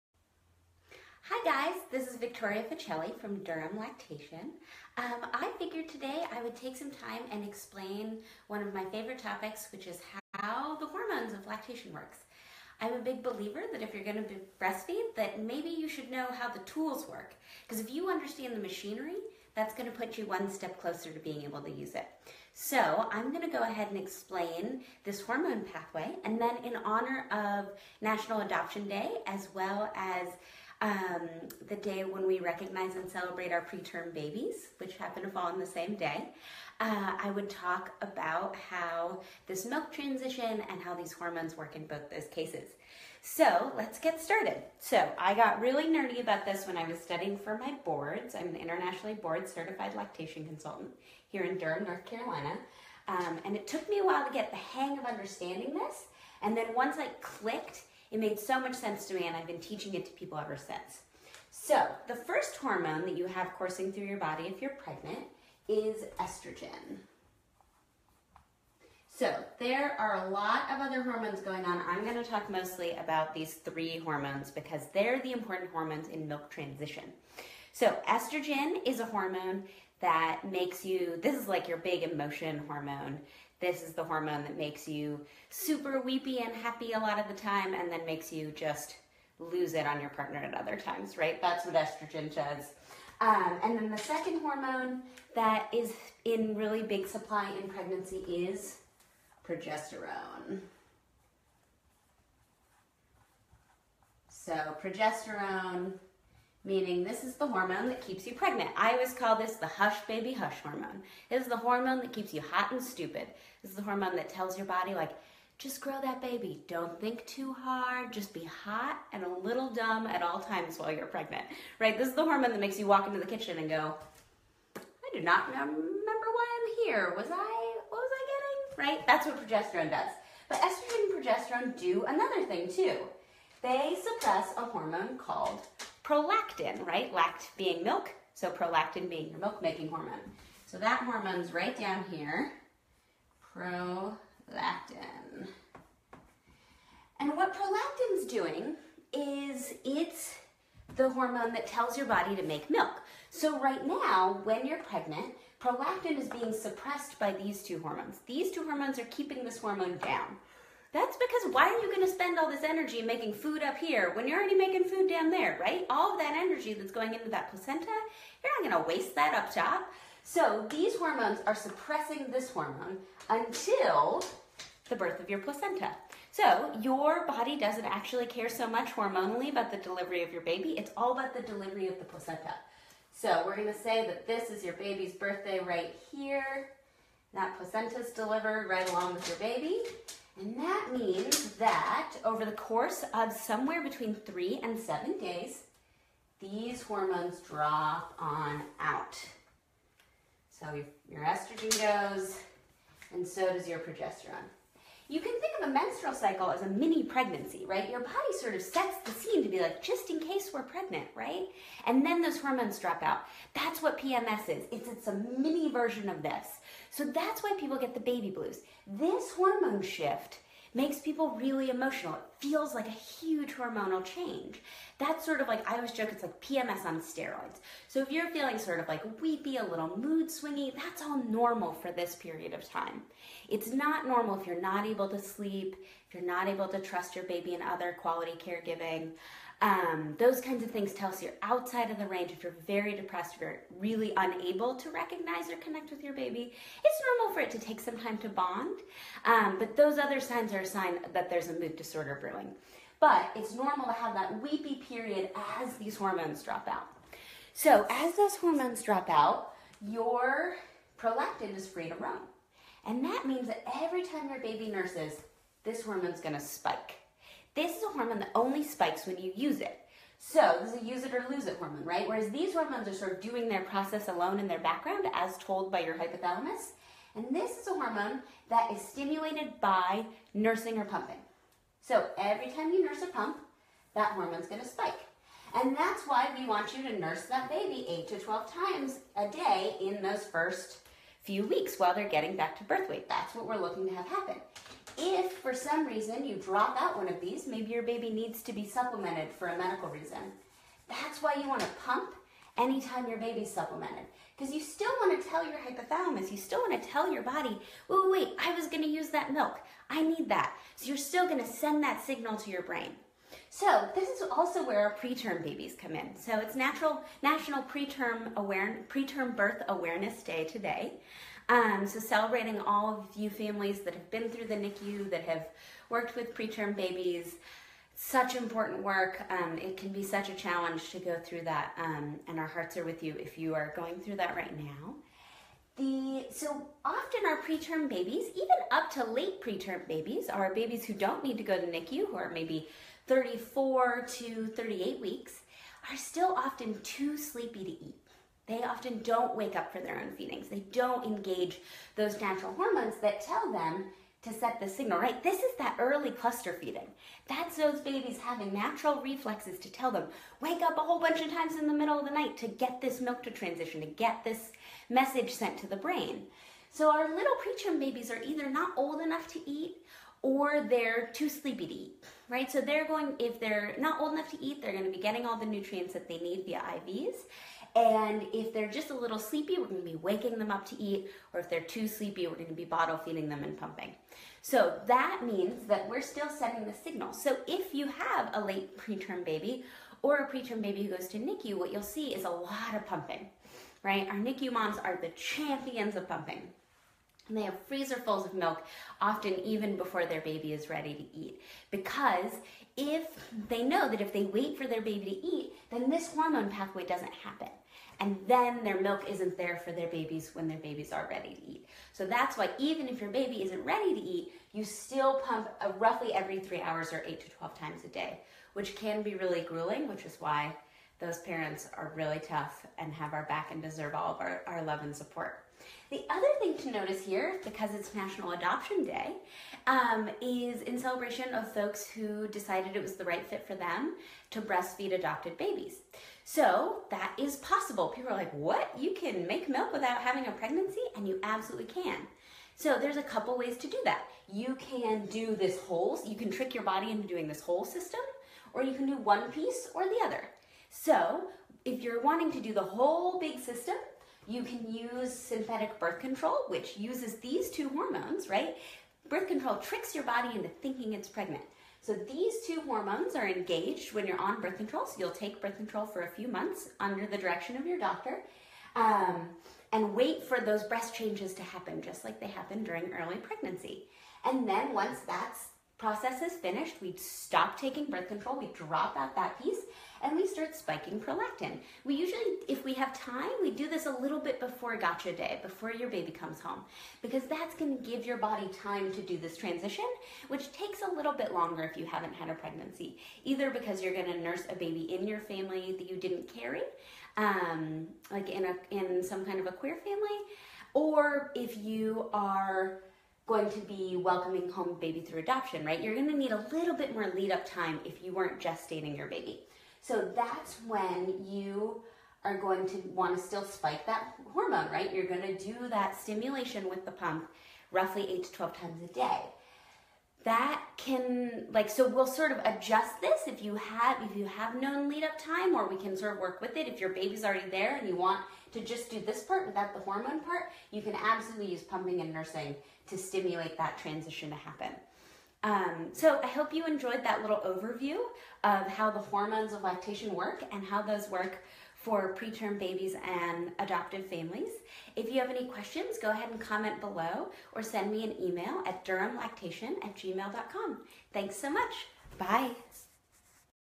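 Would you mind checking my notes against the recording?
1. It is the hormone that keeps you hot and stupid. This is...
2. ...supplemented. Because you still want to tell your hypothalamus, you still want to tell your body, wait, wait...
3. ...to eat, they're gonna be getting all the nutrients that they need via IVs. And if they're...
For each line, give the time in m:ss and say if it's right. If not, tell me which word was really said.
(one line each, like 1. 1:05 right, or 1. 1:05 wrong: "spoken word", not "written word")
1. 1:51 right
2. 5:03 right
3. 6:14 right.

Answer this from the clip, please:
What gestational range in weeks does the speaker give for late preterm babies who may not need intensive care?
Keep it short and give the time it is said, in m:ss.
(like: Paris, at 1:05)
34 to 38 weeks, at 5:43.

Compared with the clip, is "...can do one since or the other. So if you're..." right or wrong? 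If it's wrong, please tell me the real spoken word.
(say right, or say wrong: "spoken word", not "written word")
wrong: "piece", not "since".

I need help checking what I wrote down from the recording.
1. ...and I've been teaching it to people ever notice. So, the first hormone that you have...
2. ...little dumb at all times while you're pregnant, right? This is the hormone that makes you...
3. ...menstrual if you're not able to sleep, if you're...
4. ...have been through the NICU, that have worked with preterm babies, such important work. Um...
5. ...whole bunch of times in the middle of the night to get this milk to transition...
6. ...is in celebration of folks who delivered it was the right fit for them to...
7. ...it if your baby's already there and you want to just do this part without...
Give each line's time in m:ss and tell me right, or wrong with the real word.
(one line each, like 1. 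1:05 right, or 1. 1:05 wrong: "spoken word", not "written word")
1. 0:59 wrong: "since", not "notice"
2. 1:59 right
3. 3:54 wrong: "normal", not "menstrual"
4. 5:23 right
5. 6:00 right
6. 7:10 wrong: "decided", not "delivered"
7. 8:46 right.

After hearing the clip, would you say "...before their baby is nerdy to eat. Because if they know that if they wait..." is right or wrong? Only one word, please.
wrong.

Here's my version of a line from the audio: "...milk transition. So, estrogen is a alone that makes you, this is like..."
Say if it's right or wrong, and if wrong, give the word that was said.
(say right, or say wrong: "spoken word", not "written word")
wrong: "hormone", not "alone".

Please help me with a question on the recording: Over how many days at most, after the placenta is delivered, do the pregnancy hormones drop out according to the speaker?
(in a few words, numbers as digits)
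7.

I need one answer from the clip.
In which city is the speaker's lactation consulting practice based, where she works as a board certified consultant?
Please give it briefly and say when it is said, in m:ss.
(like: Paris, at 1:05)
Durham, North Carolina, at 0:51.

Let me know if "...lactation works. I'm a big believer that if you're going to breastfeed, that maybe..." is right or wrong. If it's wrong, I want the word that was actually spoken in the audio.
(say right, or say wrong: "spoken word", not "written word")
right.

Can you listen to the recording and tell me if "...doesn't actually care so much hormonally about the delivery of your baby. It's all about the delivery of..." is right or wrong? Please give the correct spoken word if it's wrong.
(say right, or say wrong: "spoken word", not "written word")
right.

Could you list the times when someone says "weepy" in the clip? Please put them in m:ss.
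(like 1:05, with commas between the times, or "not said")
1:26, 3:49, 4:14.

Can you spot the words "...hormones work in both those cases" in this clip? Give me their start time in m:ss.
0:41.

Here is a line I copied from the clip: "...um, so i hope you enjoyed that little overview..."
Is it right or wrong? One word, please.
right.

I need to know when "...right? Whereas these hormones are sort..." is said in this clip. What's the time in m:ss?
4:31.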